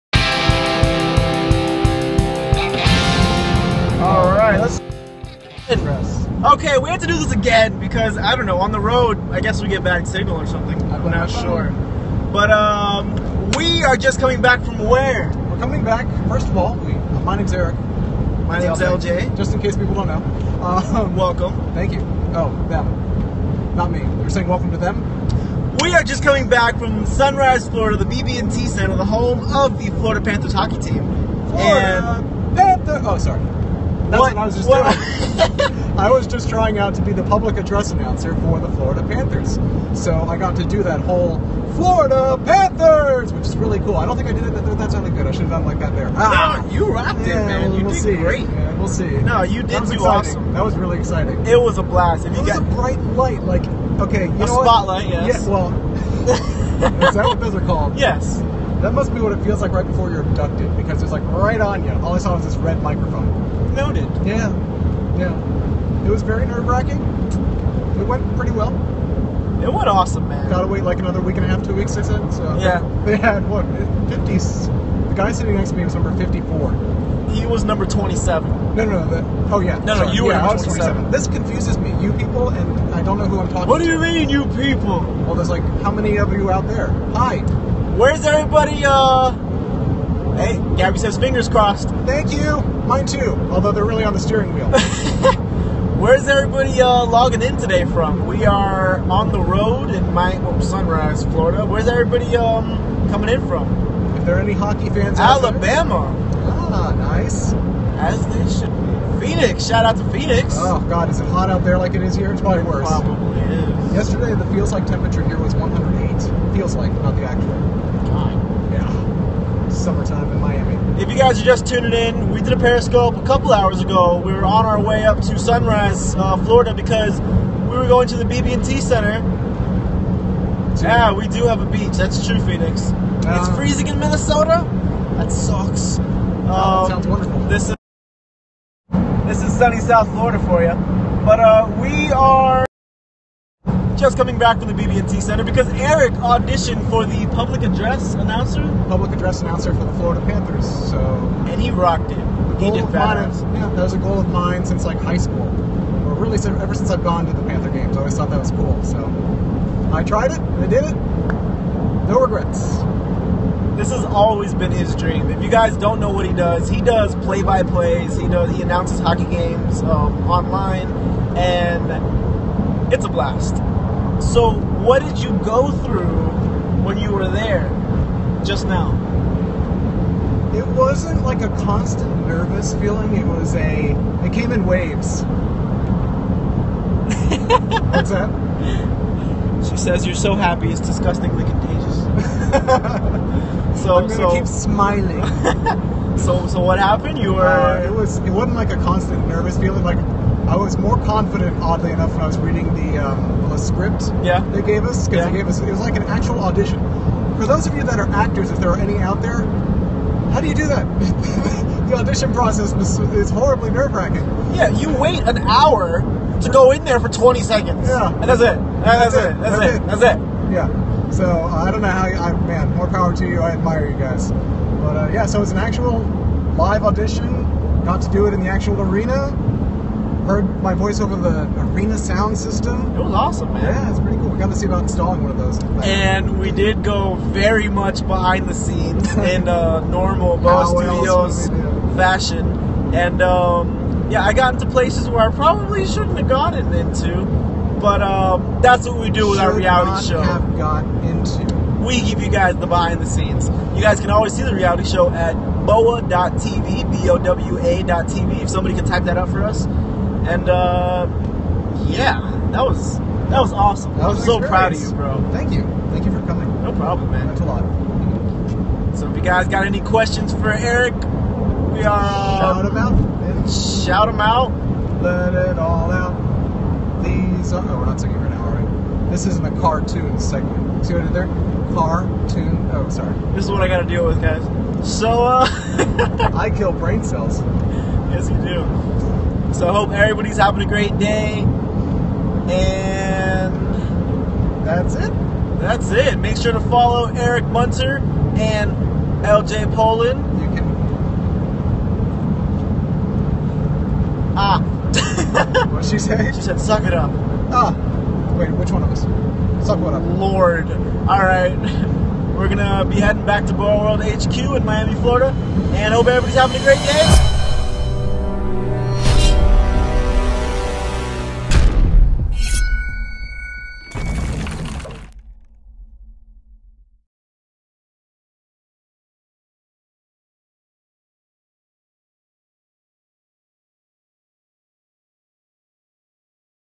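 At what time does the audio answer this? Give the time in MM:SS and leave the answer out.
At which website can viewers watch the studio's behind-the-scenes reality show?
04:15.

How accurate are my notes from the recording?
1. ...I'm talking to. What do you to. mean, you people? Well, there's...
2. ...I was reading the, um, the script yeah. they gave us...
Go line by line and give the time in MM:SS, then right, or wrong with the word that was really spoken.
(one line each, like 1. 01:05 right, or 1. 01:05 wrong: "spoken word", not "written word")
1. 01:23 right
2. 03:22 right.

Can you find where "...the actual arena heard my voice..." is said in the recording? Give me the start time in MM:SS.
03:48.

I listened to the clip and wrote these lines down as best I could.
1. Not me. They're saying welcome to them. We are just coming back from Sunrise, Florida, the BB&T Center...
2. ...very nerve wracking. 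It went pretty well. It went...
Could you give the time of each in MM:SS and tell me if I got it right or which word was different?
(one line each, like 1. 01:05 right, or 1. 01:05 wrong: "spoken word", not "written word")
1. 00:23 right
2. 01:06 right.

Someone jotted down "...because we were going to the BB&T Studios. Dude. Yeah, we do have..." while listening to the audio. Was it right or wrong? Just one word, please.
wrong.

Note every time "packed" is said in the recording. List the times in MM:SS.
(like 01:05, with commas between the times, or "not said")
not said.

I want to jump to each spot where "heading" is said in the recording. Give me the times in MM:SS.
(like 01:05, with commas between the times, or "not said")
05:12.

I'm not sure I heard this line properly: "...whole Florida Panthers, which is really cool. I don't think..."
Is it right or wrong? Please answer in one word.
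right.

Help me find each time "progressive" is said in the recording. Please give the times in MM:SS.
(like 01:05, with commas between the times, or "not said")
not said.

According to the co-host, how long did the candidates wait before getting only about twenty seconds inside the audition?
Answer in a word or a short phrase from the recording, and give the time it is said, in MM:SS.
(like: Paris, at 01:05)
an hour, at 03:35.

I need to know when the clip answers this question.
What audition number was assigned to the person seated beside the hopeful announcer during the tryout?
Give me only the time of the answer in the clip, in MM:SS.
01:15.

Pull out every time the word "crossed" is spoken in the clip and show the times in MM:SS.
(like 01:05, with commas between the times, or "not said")
01:31.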